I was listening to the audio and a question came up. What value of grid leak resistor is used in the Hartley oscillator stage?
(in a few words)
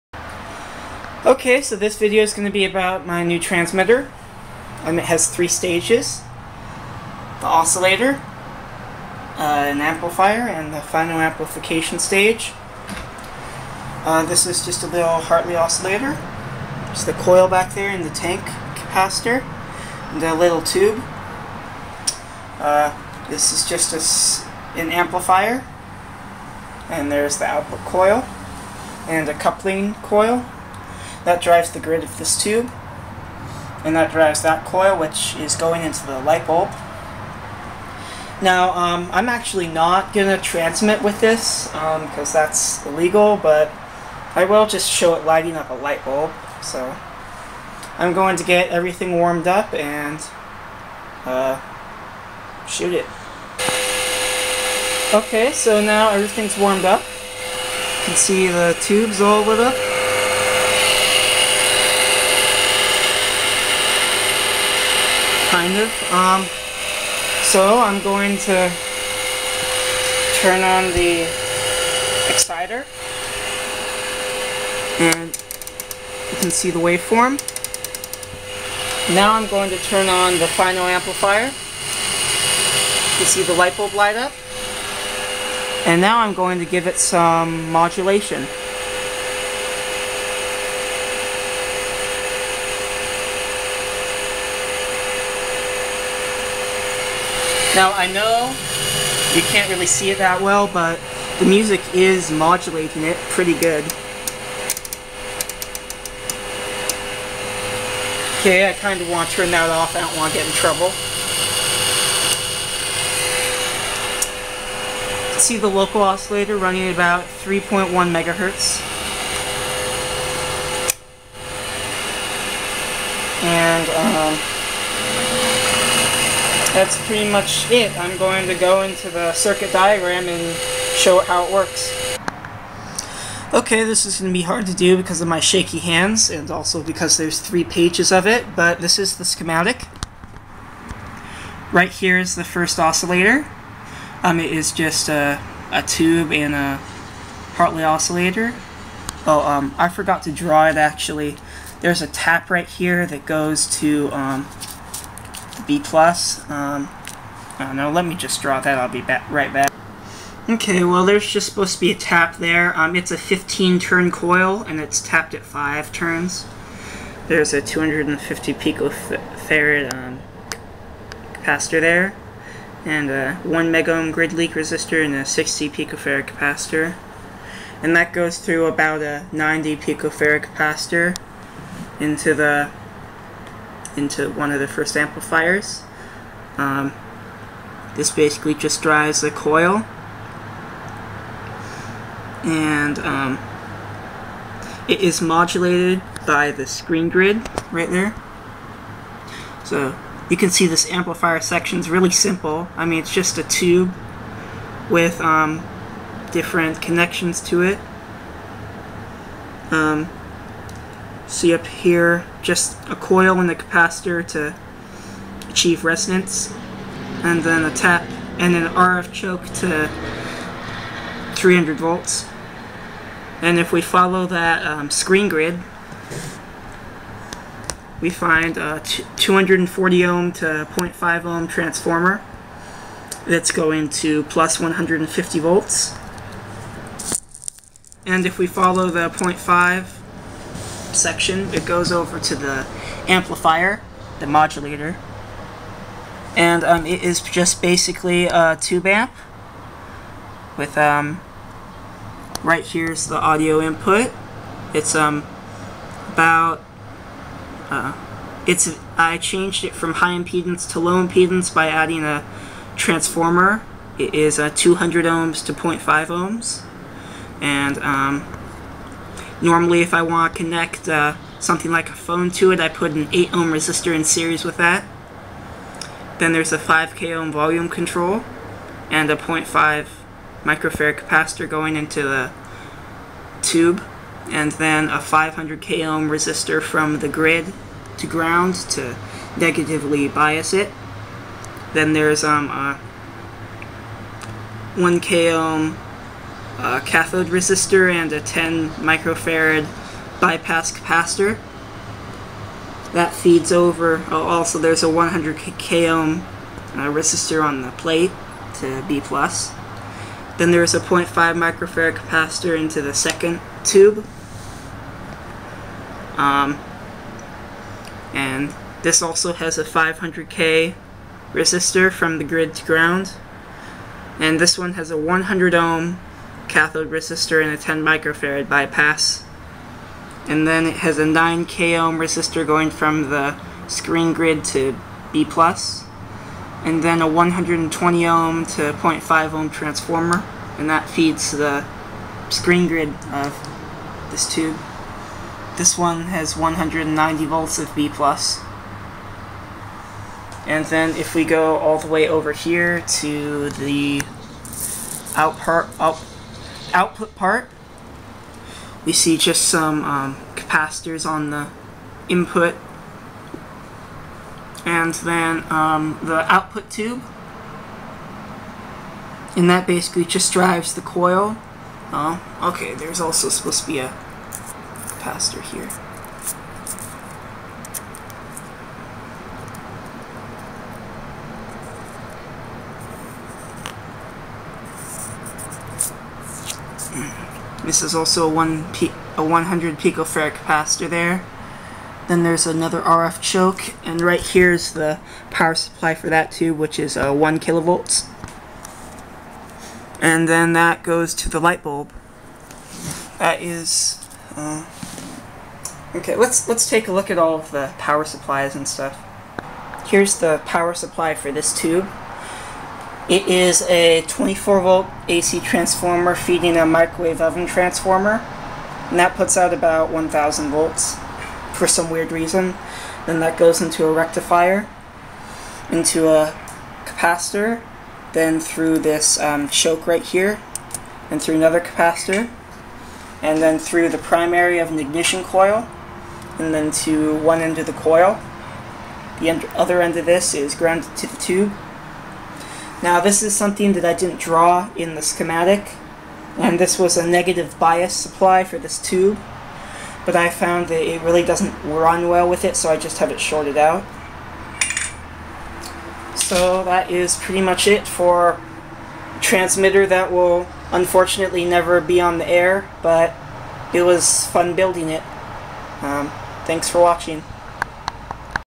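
1 megohm.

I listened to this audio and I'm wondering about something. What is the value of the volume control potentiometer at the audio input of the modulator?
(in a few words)
5k ohm.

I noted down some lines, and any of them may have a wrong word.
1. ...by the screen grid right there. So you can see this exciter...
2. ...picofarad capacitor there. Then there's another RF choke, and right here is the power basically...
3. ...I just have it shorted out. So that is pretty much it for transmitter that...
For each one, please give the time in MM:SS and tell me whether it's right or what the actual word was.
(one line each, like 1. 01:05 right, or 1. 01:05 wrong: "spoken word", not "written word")
1. 03:16 wrong: "amplifier", not "exciter"
2. 06:29 wrong: "supply", not "basically"
3. 07:32 right.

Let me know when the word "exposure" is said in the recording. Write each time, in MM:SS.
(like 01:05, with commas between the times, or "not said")
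not said.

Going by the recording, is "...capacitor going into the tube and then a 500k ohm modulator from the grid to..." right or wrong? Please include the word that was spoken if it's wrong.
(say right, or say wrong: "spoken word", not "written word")
wrong: "resistor", not "modulator".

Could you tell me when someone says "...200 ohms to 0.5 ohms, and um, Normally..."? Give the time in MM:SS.
04:24.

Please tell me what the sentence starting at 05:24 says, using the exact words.
And this one has a 100 ohm cathode resistor and a 10 microfarad bypass.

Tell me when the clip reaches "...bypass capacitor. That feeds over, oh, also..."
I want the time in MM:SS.
05:00.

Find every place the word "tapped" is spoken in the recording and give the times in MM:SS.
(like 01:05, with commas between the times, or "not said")
02:44.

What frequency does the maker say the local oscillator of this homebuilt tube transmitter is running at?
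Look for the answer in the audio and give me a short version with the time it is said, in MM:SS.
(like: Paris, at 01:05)
3.1 megahertz, at 01:57.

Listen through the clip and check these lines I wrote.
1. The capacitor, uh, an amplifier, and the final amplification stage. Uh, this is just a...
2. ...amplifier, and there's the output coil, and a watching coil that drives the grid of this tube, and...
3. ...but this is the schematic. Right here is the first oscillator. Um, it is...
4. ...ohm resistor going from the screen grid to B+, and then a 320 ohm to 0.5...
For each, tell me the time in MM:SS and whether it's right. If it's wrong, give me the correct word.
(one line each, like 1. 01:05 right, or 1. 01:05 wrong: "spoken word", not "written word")
1. 00:07 wrong: "oscillator", not "capacitor"
2. 00:24 wrong: "coupling", not "watching"
3. 02:18 right
4. 05:31 wrong: "120", not "320".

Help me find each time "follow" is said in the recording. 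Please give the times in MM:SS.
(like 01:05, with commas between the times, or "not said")
03:43, 03:58.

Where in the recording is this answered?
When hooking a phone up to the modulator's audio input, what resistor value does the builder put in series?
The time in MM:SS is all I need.
04:33.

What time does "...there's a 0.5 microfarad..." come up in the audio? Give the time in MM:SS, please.
05:10.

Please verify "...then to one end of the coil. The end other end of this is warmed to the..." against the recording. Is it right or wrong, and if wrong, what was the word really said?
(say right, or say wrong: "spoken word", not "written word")
wrong: "grounded", not "warmed".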